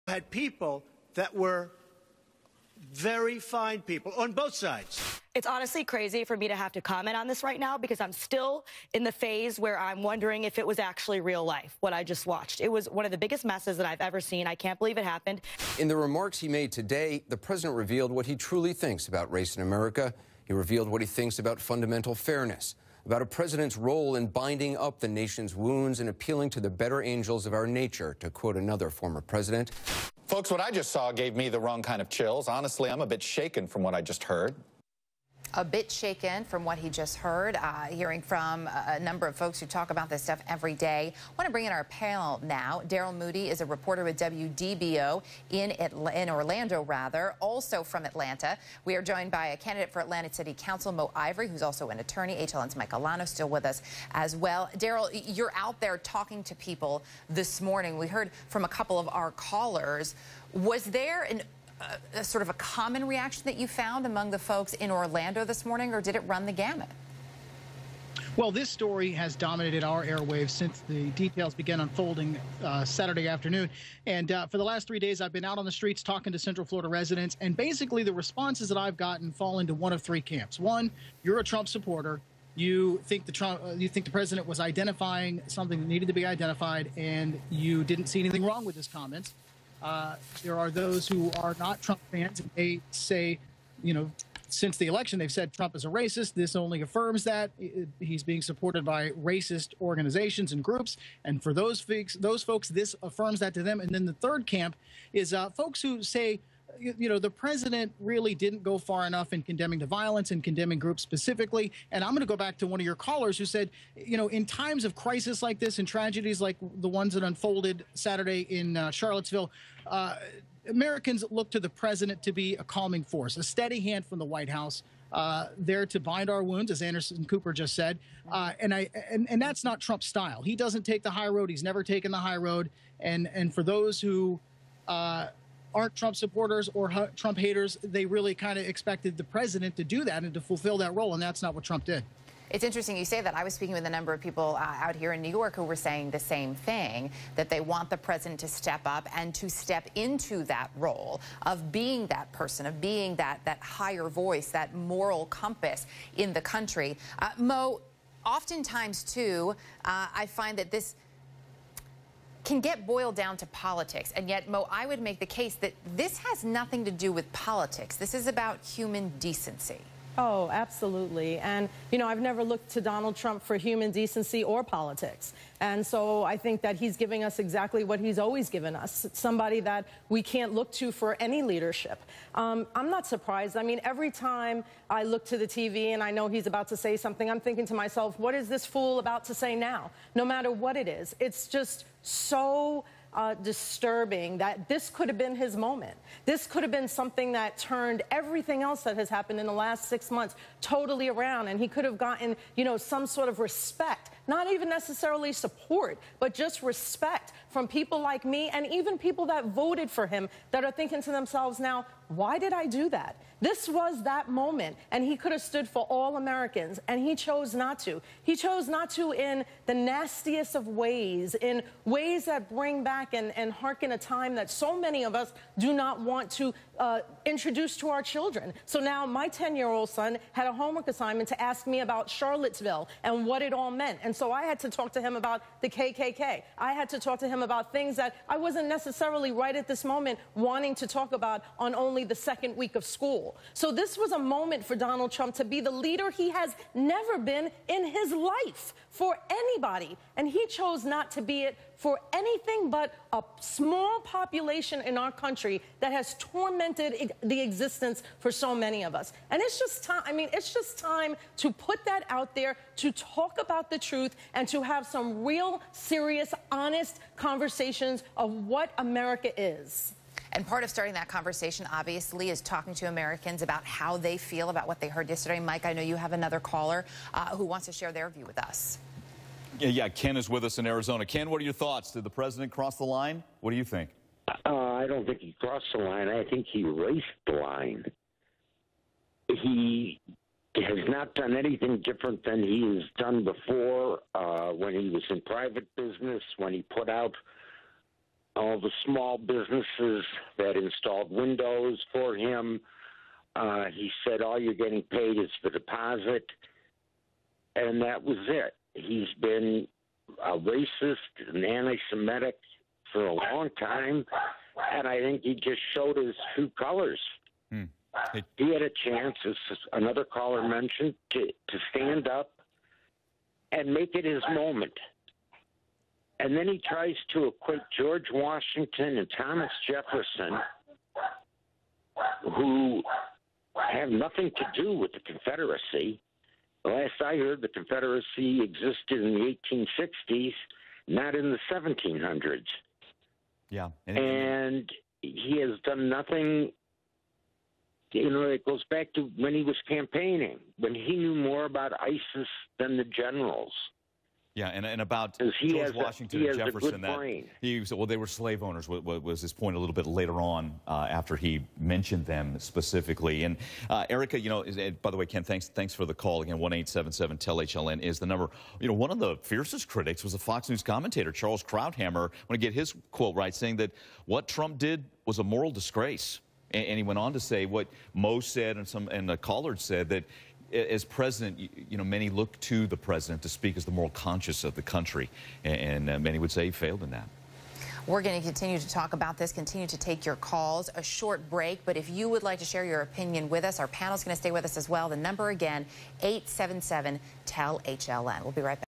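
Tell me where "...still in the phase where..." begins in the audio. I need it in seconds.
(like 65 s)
8 s.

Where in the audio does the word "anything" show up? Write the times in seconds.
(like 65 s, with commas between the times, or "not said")
88 s, 252 s, 291 s.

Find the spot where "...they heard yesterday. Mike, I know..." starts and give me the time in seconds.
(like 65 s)
274 s.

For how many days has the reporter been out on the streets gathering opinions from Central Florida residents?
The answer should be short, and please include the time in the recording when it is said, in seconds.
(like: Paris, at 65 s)
3, at 74 s.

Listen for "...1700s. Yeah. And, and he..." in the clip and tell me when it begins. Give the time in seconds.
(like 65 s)
341 s.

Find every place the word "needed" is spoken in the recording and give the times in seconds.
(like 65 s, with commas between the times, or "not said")
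85 s.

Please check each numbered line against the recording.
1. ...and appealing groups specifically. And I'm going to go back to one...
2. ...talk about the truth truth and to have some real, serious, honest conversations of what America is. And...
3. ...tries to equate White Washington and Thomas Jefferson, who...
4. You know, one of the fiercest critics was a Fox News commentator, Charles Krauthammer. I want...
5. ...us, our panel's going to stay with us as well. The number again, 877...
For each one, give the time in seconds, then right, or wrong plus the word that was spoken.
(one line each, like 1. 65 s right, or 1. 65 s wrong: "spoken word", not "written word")
1. 110 s wrong: "condemning", not "appealing"
2. 262 s right
3. 326 s wrong: "George", not "White"
4. 368 s right
5. 393 s right.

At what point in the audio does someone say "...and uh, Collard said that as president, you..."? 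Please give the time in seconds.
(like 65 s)
378 s.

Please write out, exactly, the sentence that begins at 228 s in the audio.
So now my 10 year old son had a homework assignment to ask me about Charlottesville and what it all meant.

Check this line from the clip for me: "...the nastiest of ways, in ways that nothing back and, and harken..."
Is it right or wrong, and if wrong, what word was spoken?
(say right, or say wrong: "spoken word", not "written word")
wrong: "bring", not "nothing".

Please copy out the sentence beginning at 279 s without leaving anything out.
Yeah, yeah, Ken is with us in Arizona.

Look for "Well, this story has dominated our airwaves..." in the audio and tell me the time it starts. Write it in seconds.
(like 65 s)
68 s.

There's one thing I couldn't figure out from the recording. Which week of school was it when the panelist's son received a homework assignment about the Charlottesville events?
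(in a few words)
Second week.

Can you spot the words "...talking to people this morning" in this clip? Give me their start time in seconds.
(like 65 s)
55 s.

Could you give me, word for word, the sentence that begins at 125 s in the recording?
Uh, there to bind our wounds, as Anderson Cooper just said.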